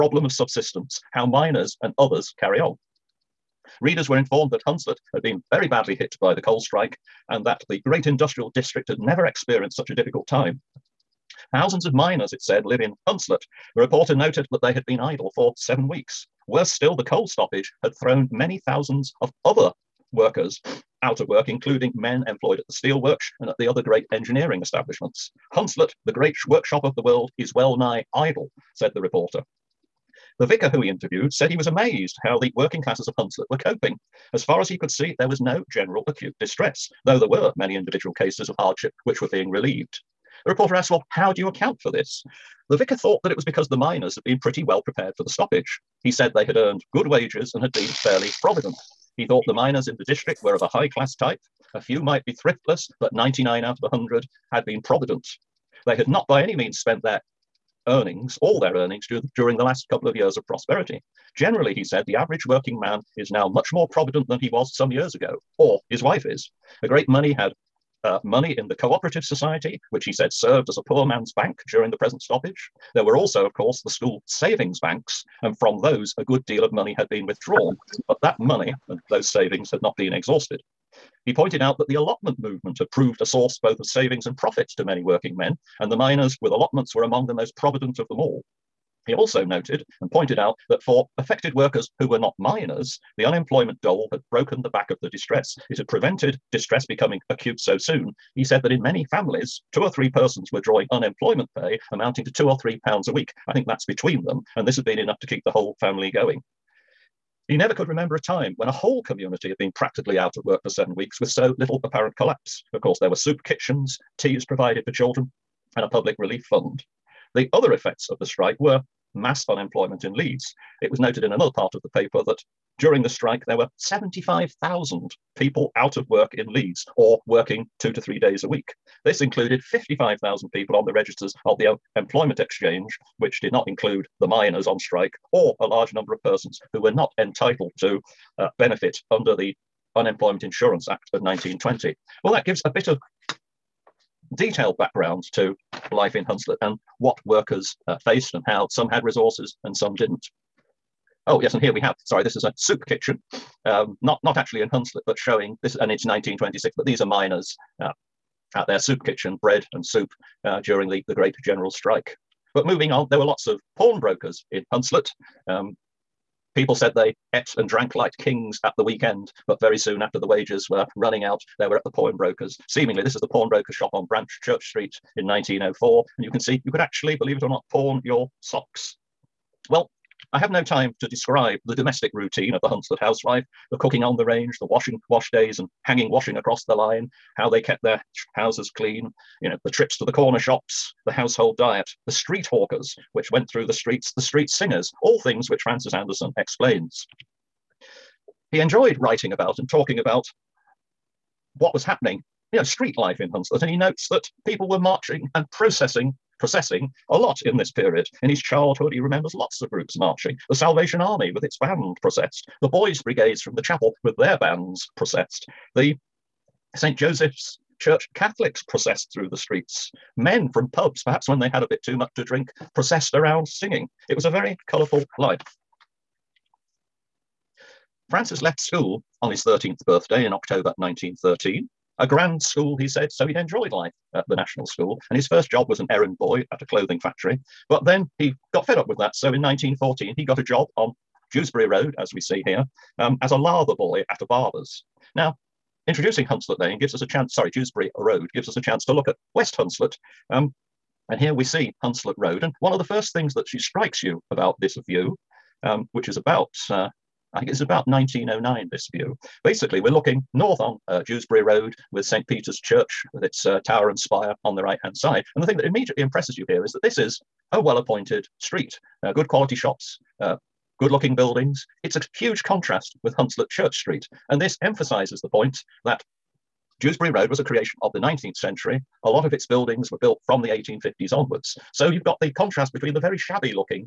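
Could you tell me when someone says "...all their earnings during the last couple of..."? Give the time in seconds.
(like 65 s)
58 s.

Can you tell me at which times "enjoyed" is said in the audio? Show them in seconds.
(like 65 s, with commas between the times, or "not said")
198 s, 233 s.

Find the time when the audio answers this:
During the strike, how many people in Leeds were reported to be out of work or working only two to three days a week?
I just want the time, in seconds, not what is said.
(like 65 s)
123 s.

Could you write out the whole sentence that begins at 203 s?
And he notes that people were marching and processing, processing a lot in this period.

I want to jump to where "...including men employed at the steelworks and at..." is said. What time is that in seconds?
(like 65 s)
21 s.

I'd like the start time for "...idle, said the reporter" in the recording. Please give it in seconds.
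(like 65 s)
28 s.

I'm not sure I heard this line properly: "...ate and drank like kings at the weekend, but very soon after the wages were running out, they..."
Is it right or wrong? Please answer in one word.
right.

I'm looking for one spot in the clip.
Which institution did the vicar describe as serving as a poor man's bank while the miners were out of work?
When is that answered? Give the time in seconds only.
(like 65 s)
68 s.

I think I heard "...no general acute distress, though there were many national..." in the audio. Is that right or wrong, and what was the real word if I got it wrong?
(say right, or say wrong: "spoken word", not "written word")
wrong: "individual", not "national".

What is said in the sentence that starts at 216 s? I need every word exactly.
Joseph's church Catholics processed through the streets.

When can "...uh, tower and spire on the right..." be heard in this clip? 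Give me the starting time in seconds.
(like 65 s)
263 s.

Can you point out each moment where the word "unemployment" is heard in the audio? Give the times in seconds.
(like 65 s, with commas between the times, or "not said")
93 s, 100 s, 119 s, 139 s.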